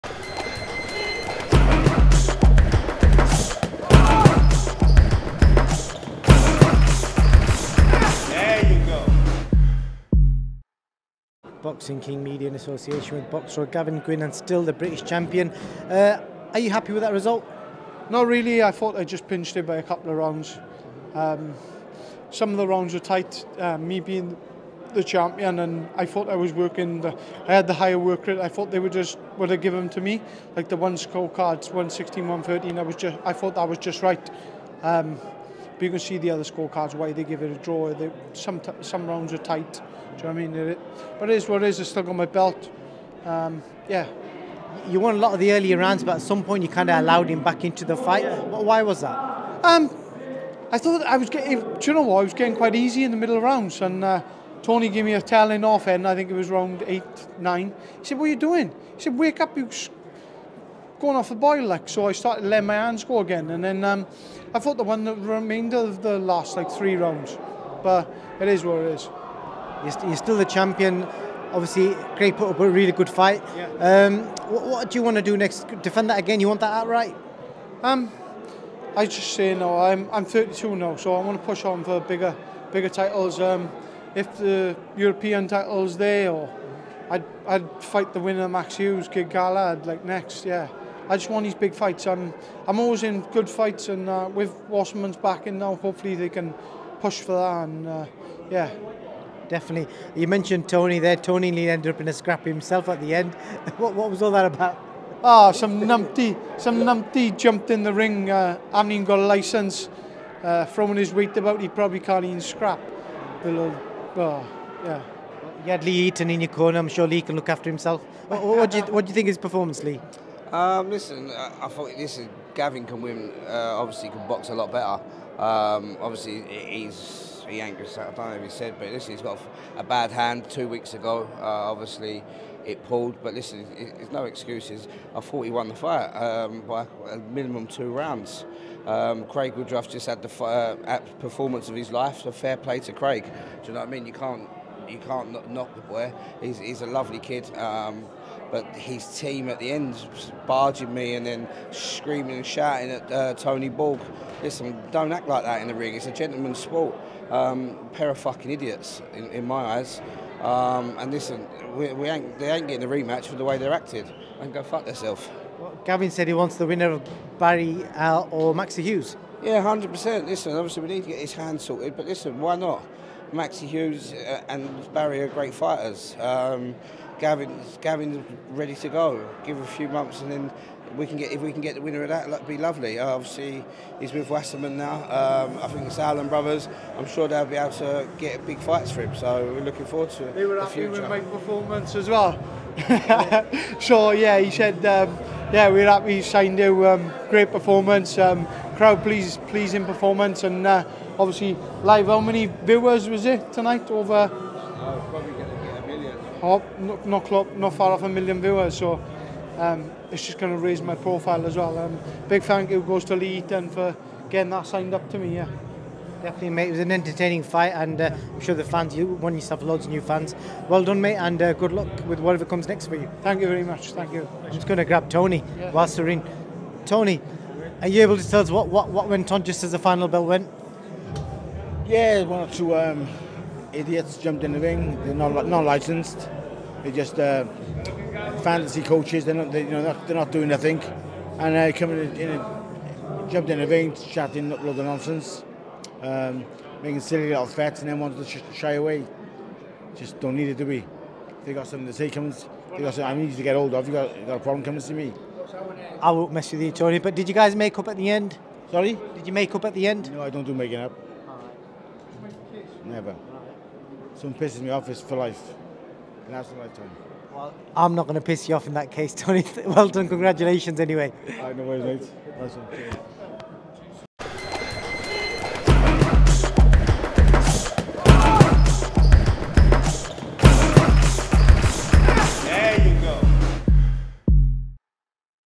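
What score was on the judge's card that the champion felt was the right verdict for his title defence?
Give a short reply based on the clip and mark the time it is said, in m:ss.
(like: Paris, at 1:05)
116-113, at 0:31.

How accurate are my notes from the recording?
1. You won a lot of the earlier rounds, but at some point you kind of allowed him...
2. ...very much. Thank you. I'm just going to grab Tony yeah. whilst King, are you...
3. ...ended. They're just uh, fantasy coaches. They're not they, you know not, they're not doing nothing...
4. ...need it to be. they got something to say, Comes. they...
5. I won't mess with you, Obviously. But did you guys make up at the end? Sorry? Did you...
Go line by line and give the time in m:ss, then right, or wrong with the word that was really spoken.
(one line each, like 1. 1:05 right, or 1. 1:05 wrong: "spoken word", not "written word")
1. 0:44 right
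2. 3:43 wrong: "Tony", not "King"
3. 3:55 wrong: "licensed", not "ended"
4. 4:10 right
5. 4:16 wrong: "Tony", not "Obviously".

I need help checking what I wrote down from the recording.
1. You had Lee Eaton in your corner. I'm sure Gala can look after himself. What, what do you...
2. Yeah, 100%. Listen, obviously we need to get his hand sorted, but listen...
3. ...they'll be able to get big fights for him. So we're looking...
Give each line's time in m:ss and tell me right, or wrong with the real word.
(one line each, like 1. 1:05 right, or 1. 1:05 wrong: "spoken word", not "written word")
1. 1:55 wrong: "Lee", not "Gala"
2. 2:49 right
3. 3:07 right.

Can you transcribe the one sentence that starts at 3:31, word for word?
Um, big thank you goes to Lee Eaton for getting that signed up to me.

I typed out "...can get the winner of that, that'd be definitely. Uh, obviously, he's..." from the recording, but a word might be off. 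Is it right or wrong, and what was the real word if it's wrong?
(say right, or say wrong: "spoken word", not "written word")
wrong: "lovely", not "definitely".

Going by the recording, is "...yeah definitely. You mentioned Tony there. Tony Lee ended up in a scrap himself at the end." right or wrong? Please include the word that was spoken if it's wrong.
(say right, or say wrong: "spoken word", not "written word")
right.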